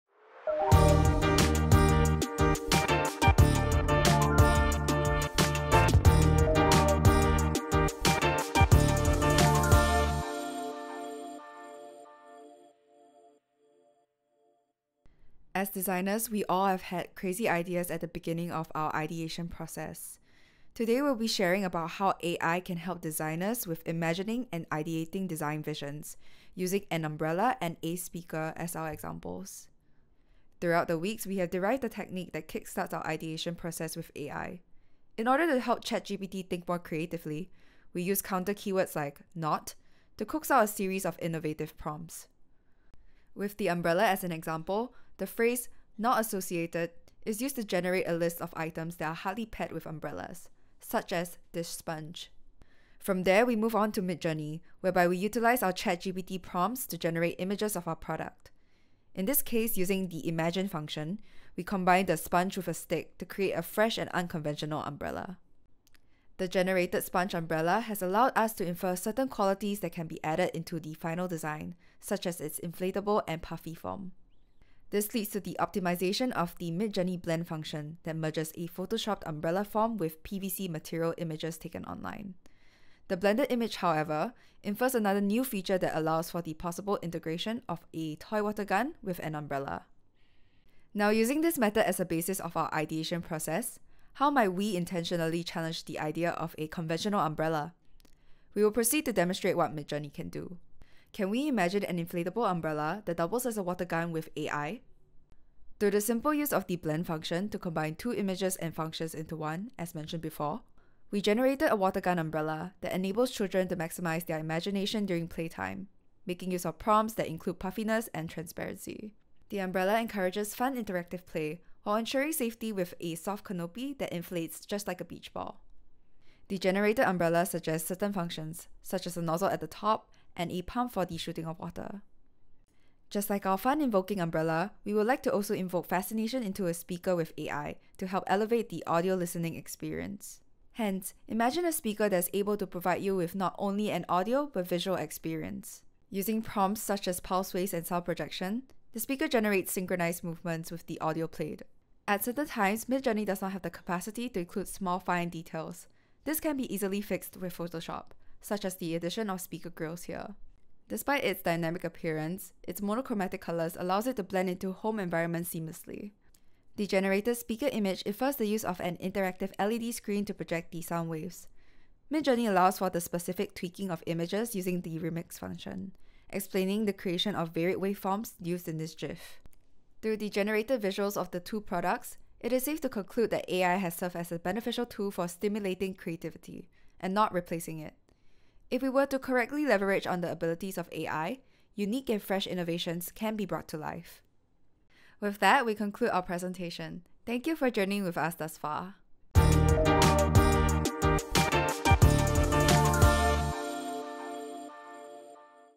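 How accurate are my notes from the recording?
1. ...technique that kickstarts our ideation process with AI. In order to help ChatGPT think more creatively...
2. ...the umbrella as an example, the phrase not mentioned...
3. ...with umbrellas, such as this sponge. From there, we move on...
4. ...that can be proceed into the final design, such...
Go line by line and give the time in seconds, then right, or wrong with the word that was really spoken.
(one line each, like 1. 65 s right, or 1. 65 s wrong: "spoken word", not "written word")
1. 31 s right
2. 43 s wrong: "associated", not "mentioned"
3. 49 s right
4. 69 s wrong: "added", not "proceed".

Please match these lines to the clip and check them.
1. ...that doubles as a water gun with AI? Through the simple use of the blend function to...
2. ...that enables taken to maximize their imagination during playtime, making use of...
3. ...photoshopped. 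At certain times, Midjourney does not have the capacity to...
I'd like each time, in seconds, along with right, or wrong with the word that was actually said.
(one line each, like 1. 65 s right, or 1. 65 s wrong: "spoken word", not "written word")
1. 103 s right
2. 112 s wrong: "children", not "taken"
3. 151 s wrong: "played", not "photoshopped".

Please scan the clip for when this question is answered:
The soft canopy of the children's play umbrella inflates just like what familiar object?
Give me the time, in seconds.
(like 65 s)
125 s.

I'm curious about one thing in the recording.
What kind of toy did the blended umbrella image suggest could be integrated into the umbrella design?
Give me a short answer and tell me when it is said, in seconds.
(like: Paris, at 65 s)
toy water gun, at 88 s.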